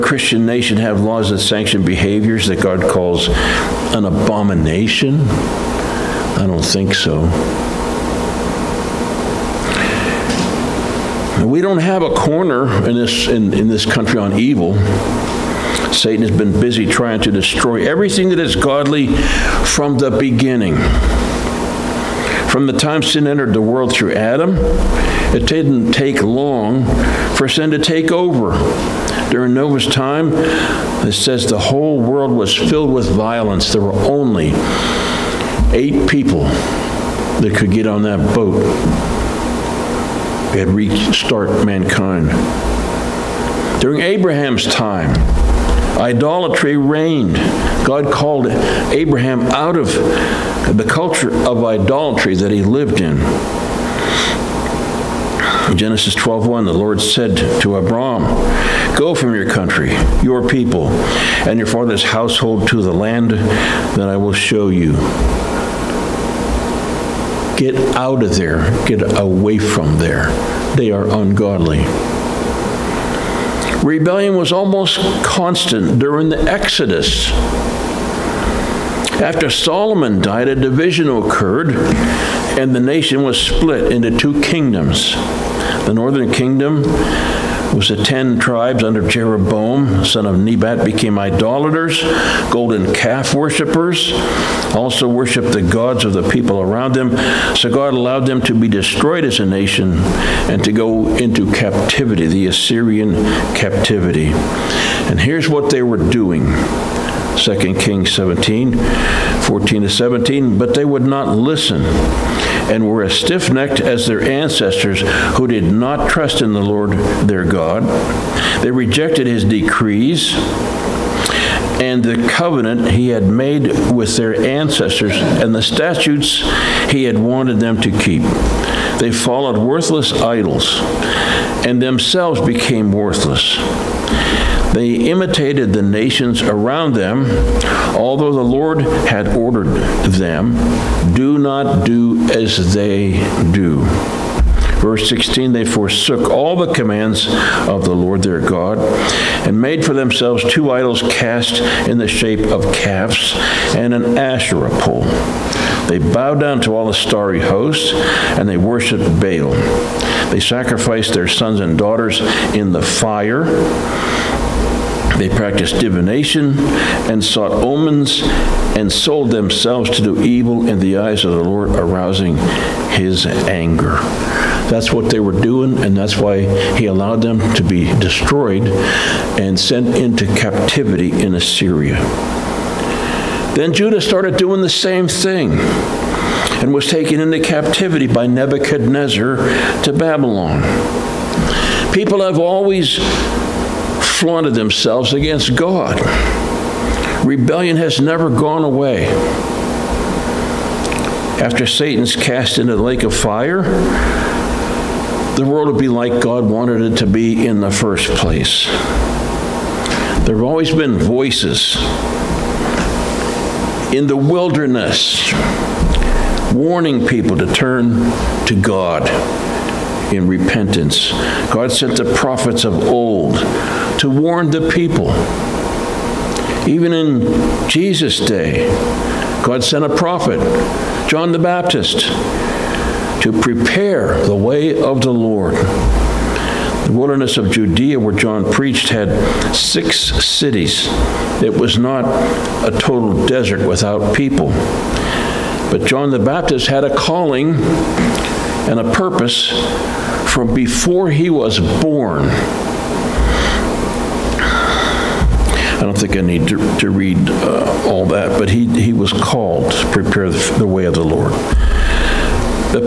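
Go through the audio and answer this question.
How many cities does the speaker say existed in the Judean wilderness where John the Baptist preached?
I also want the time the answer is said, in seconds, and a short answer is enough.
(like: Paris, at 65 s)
6, at 239 s.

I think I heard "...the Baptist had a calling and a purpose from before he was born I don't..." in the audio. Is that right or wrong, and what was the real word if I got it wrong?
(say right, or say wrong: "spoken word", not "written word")
right.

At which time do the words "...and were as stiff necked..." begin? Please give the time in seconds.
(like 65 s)
112 s.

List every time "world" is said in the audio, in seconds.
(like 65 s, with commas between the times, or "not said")
23 s, 31 s, 205 s.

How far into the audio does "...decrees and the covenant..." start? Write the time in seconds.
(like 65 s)
119 s.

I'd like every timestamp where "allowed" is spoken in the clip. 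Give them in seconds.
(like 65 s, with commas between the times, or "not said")
97 s, 176 s.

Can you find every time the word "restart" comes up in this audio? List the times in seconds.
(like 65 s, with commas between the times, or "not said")
40 s.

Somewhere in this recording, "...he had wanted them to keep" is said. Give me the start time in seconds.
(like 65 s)
126 s.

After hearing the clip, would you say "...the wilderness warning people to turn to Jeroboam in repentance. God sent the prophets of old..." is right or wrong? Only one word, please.
wrong.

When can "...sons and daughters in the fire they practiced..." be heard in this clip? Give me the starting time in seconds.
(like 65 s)
161 s.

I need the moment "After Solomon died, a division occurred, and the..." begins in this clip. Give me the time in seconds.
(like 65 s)
79 s.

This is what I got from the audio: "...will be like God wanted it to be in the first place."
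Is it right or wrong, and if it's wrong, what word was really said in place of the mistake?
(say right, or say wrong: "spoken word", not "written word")
right.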